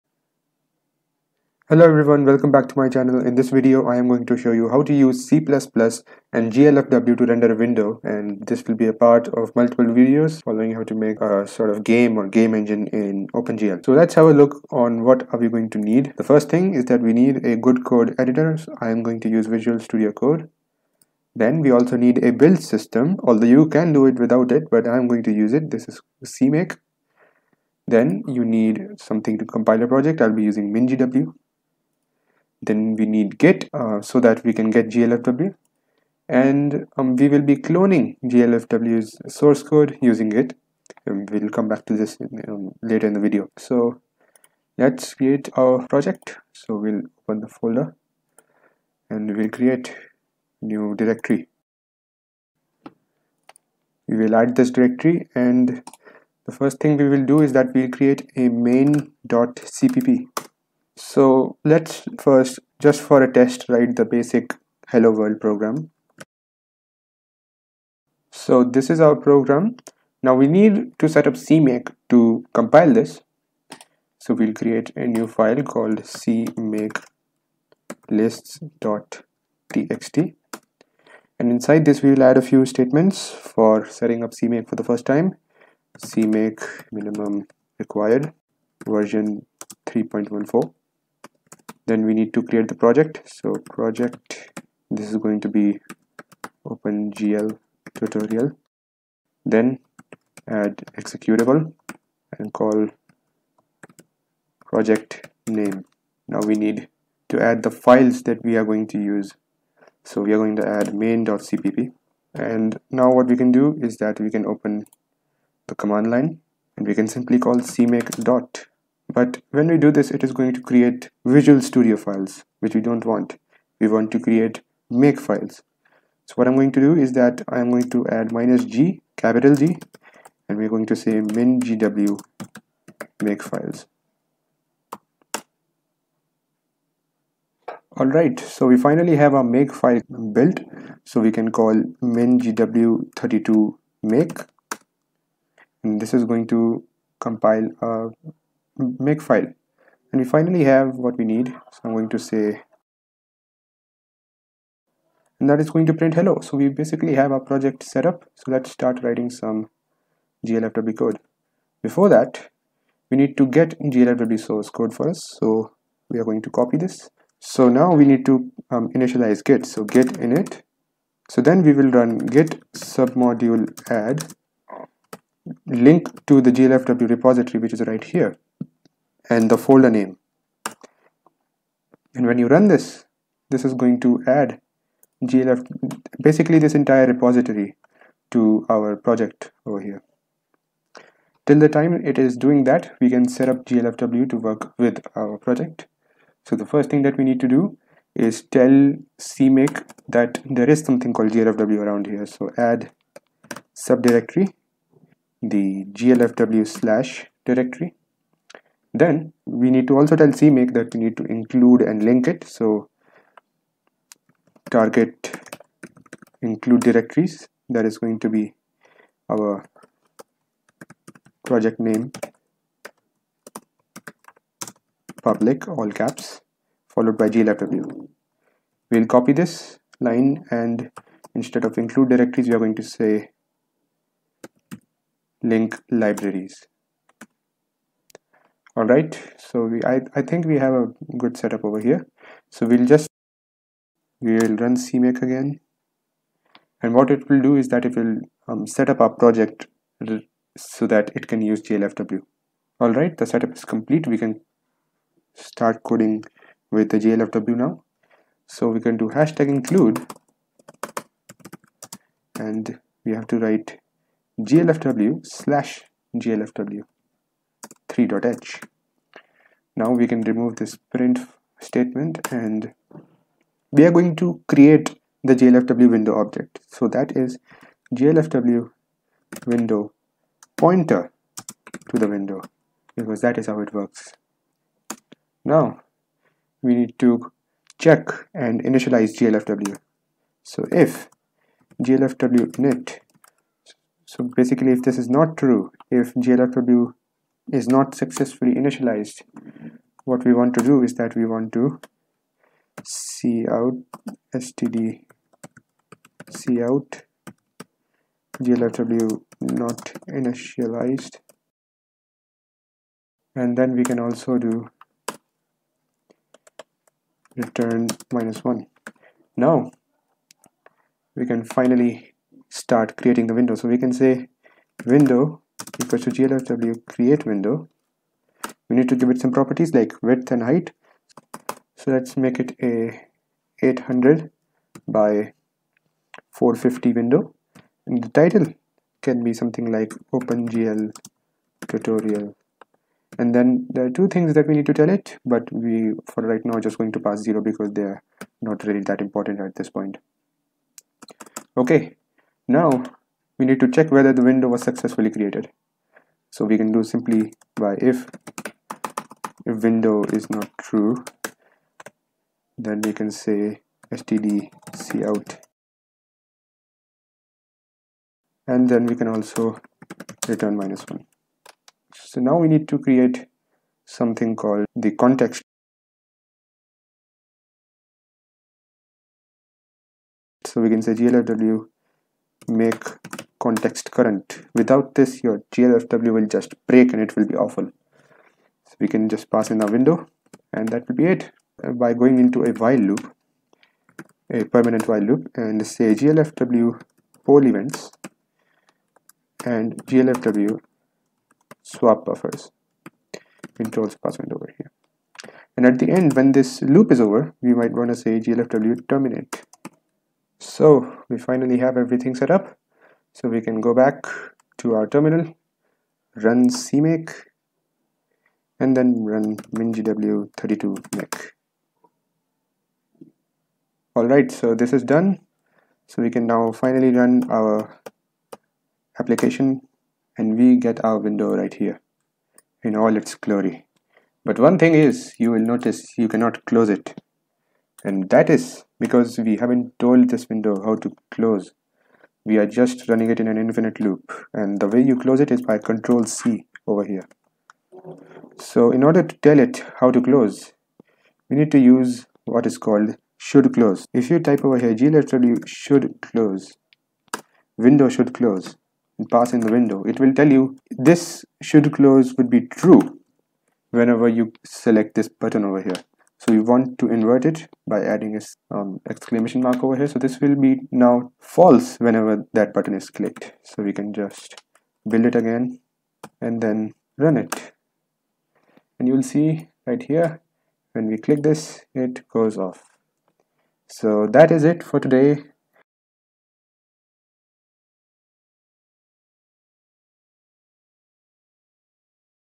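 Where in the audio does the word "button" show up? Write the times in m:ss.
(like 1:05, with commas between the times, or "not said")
7:45, 7:52.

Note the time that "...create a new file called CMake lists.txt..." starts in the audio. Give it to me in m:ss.
1:14.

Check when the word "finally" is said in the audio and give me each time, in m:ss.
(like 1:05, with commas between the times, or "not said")
2:18, 2:30, 5:21, 6:51, 7:06.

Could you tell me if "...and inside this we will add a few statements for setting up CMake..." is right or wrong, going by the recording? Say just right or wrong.
right.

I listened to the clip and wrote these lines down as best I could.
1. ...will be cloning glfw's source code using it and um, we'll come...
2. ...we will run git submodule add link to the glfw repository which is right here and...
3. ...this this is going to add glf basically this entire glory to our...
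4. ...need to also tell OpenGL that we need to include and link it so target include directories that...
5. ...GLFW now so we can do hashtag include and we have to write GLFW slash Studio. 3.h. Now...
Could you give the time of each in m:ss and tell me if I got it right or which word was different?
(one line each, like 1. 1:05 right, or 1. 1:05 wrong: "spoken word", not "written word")
1. 0:37 right
2. 2:51 right
3. 3:02 wrong: "repository", not "glory"
4. 3:29 wrong: "CMake", not "OpenGL"
5. 4:16 wrong: "GLFW", not "Studio".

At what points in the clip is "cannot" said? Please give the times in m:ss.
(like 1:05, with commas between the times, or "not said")
7:16.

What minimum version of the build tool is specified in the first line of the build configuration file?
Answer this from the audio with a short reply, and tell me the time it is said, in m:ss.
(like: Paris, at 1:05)
3.14, at 1:29.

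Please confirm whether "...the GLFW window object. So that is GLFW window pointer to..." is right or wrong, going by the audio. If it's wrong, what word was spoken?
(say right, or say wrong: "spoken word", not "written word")
right.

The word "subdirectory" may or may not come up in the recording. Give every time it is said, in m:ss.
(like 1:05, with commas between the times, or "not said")
3:23.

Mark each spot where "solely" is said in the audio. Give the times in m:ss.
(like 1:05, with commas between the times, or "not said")
not said.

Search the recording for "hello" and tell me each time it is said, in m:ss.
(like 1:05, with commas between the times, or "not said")
0:01, 1:04, 2:36.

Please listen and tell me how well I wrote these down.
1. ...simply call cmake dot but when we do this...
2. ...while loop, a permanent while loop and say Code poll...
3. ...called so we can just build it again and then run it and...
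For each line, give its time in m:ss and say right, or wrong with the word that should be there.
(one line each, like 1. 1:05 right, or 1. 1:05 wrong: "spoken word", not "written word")
1. 1:57 right
2. 6:32 wrong: "GLFW", not "Code"
3. 7:52 wrong: "clicked", not "called".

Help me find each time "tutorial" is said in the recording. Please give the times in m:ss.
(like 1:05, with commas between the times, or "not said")
1:37, 5:41.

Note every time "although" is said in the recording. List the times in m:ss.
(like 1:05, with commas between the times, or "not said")
0:23.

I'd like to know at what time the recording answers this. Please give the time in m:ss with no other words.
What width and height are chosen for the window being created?
5:33.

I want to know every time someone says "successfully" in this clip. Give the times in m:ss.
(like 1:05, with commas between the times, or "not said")
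4:57, 5:54.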